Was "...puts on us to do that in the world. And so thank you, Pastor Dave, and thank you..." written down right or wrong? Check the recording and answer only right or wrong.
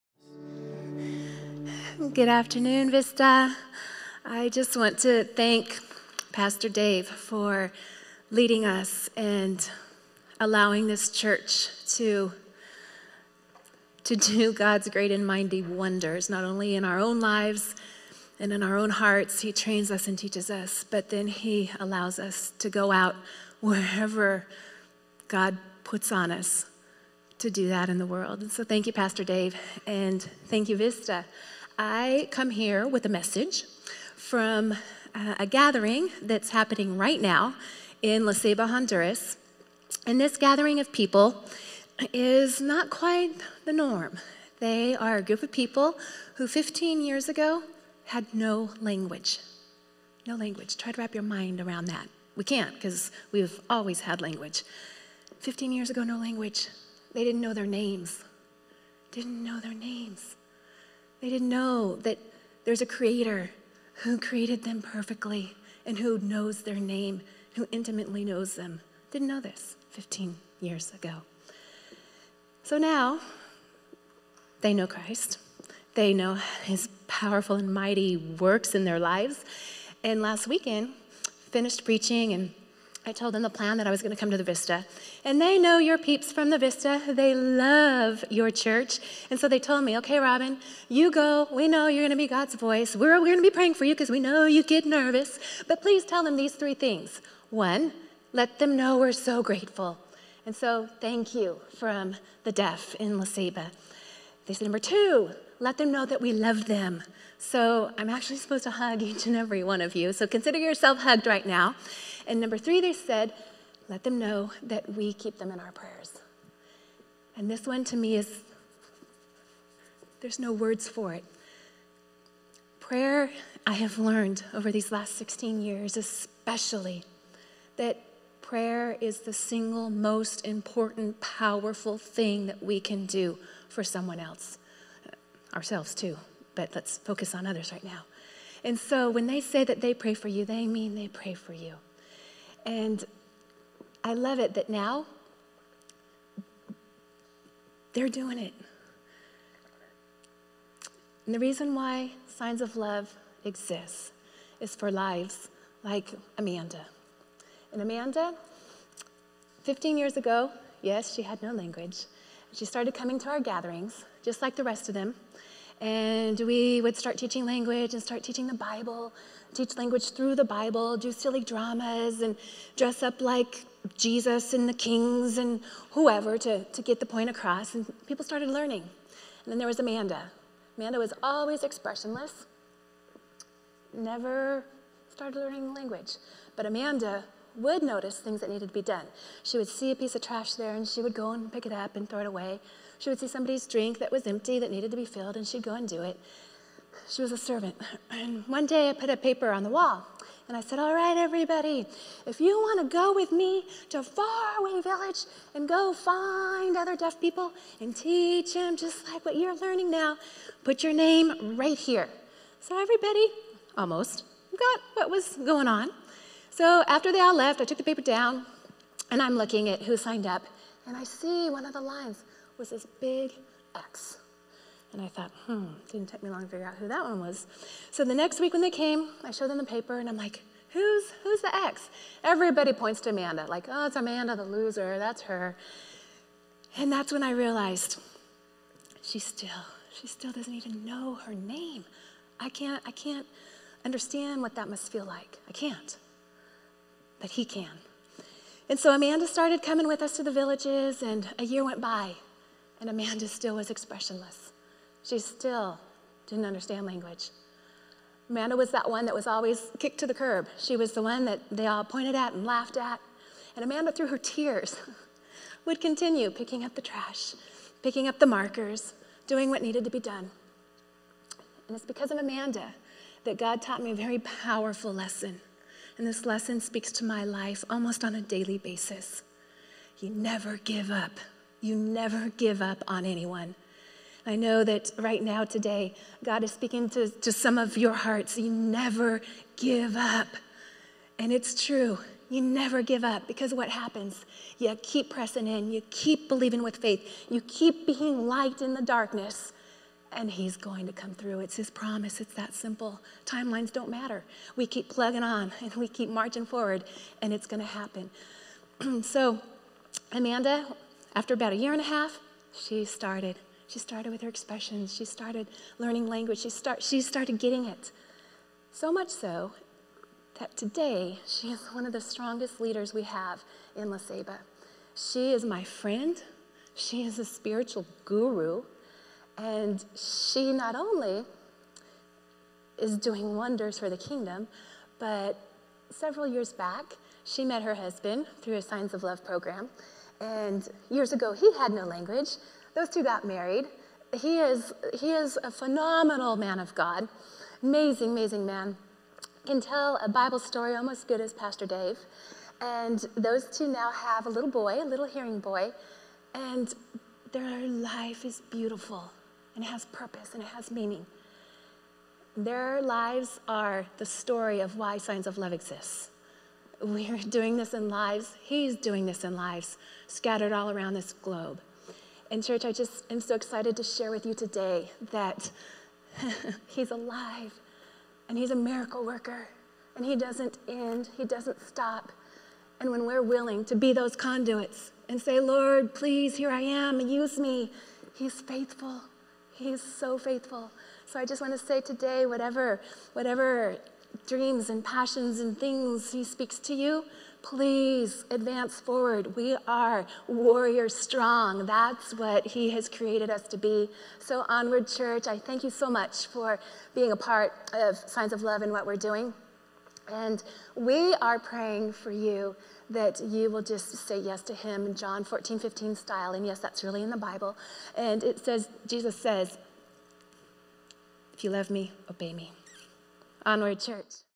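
right.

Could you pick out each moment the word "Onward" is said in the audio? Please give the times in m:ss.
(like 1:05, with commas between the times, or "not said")
6:44, 7:03.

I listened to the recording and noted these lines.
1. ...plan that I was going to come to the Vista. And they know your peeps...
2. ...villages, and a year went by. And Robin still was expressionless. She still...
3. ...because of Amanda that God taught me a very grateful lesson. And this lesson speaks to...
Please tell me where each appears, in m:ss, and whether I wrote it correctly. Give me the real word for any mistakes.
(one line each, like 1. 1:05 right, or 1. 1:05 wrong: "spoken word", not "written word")
1. 1:23 right
2. 4:10 wrong: "Amanda", not "Robin"
3. 4:31 wrong: "powerful", not "grateful".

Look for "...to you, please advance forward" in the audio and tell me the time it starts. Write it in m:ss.
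6:36.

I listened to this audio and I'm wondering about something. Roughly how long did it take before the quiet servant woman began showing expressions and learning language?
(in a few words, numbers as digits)
A year and a half.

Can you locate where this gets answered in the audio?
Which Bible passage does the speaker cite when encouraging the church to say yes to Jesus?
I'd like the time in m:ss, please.
6:54.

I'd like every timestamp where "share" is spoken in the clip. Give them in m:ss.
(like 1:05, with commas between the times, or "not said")
6:13.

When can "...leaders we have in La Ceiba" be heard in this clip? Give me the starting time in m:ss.
5:22.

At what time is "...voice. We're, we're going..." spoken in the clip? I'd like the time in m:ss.
1:32.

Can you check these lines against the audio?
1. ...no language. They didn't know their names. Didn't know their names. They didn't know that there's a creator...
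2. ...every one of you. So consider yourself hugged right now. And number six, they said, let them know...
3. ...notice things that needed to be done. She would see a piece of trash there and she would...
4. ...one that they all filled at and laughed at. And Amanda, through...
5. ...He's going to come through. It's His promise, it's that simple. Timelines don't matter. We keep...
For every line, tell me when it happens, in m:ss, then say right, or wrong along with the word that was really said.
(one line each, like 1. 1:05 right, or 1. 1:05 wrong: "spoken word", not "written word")
1. 0:56 right
2. 1:49 wrong: "three", not "six"
3. 3:07 right
4. 4:21 wrong: "pointed", not "filled"
5. 5:00 right.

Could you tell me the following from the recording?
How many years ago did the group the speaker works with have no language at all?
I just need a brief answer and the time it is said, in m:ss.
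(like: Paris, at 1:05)
15, at 0:46.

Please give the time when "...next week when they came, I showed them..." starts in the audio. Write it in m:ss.
3:48.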